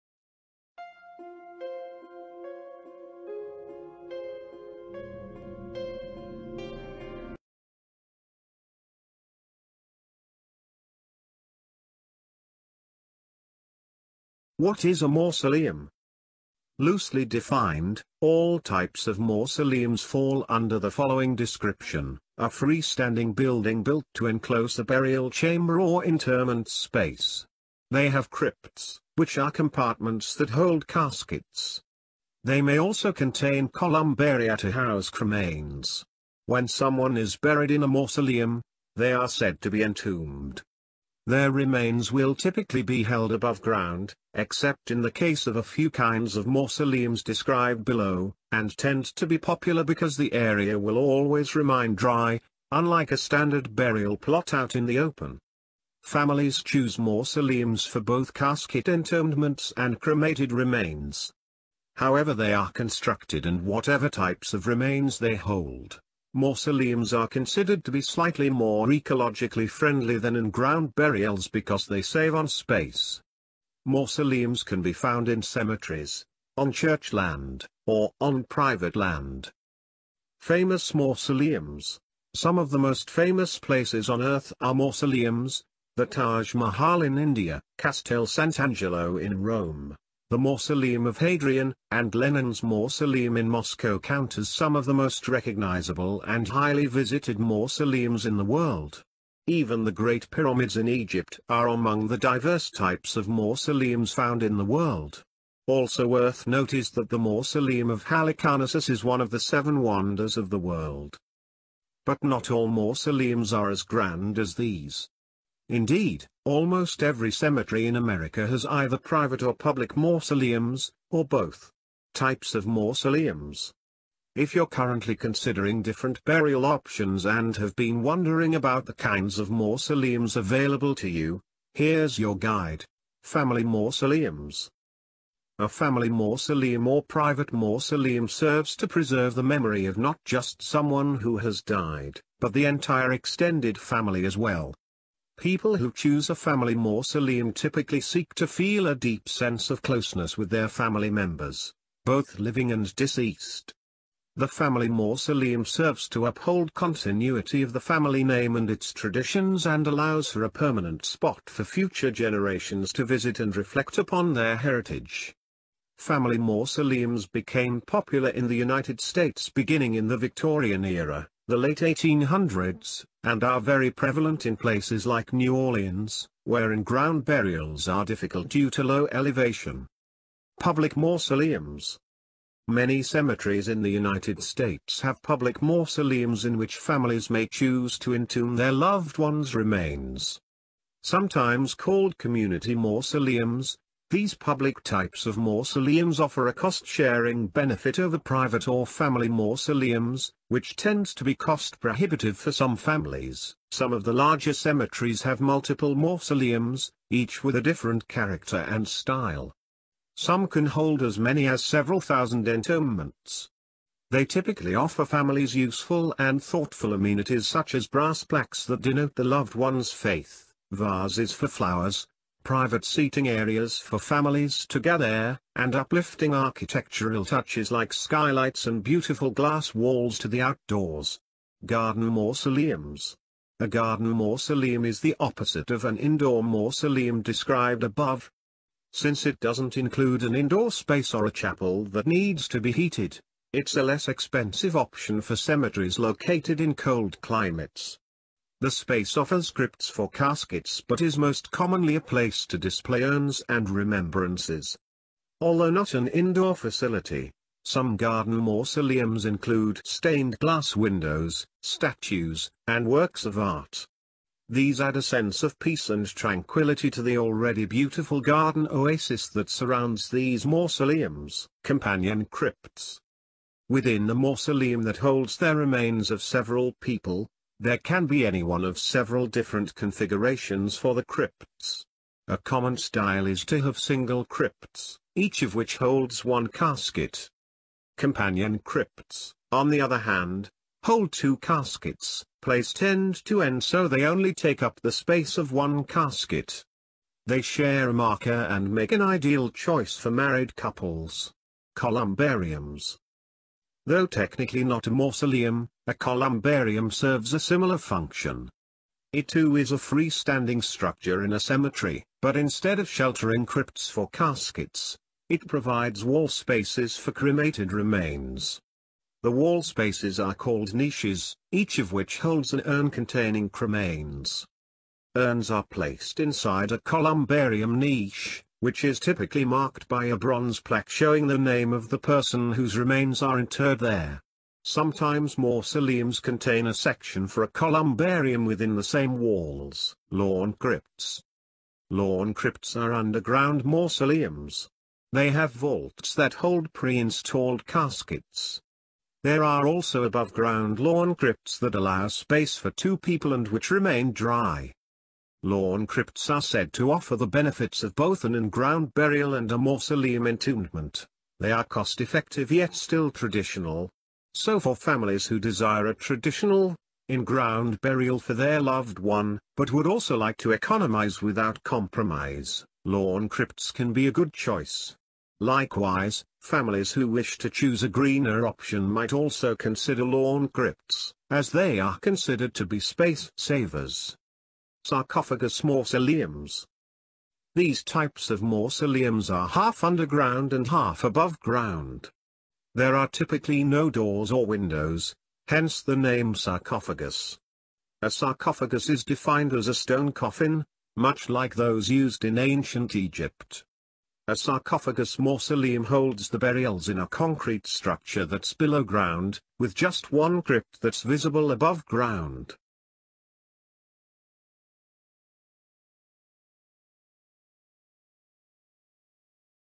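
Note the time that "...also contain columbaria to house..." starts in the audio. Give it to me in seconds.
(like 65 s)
32 s.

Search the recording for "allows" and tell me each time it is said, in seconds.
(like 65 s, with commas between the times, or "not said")
159 s, 351 s.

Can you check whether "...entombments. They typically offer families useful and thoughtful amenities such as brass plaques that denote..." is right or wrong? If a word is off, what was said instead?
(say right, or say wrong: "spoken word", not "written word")
right.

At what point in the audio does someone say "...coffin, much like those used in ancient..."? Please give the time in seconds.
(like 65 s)
400 s.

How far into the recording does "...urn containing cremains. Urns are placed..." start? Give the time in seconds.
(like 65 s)
322 s.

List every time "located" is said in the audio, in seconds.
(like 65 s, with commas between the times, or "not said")
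245 s.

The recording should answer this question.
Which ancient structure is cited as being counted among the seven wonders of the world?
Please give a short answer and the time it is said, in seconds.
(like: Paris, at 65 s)
Mausoleum of Halicarnassus, at 107 s.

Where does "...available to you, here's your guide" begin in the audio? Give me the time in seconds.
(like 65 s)
130 s.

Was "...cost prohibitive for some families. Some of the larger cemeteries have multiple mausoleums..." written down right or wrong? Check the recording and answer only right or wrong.
right.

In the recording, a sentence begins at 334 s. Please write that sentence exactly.
Sometimes mausoleums contain a section for a columbarium within the same walls.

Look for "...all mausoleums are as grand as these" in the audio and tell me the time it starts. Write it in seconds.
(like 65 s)
112 s.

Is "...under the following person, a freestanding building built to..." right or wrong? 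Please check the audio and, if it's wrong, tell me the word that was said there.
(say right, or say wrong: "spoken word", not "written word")
wrong: "description", not "person".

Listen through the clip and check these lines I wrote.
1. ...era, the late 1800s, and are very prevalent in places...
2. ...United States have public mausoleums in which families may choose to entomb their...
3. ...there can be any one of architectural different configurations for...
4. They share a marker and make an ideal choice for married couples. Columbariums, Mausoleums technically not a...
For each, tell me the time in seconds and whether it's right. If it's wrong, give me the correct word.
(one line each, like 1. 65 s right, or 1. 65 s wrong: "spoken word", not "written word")
1. 170 s right
2. 183 s right
3. 277 s wrong: "several", not "architectural"
4. 297 s wrong: "Though", not "Mausoleums".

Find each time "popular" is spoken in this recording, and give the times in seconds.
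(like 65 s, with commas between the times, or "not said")
49 s, 167 s.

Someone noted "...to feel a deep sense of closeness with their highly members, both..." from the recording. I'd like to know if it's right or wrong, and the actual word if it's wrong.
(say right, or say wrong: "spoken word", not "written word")
wrong: "family", not "highly".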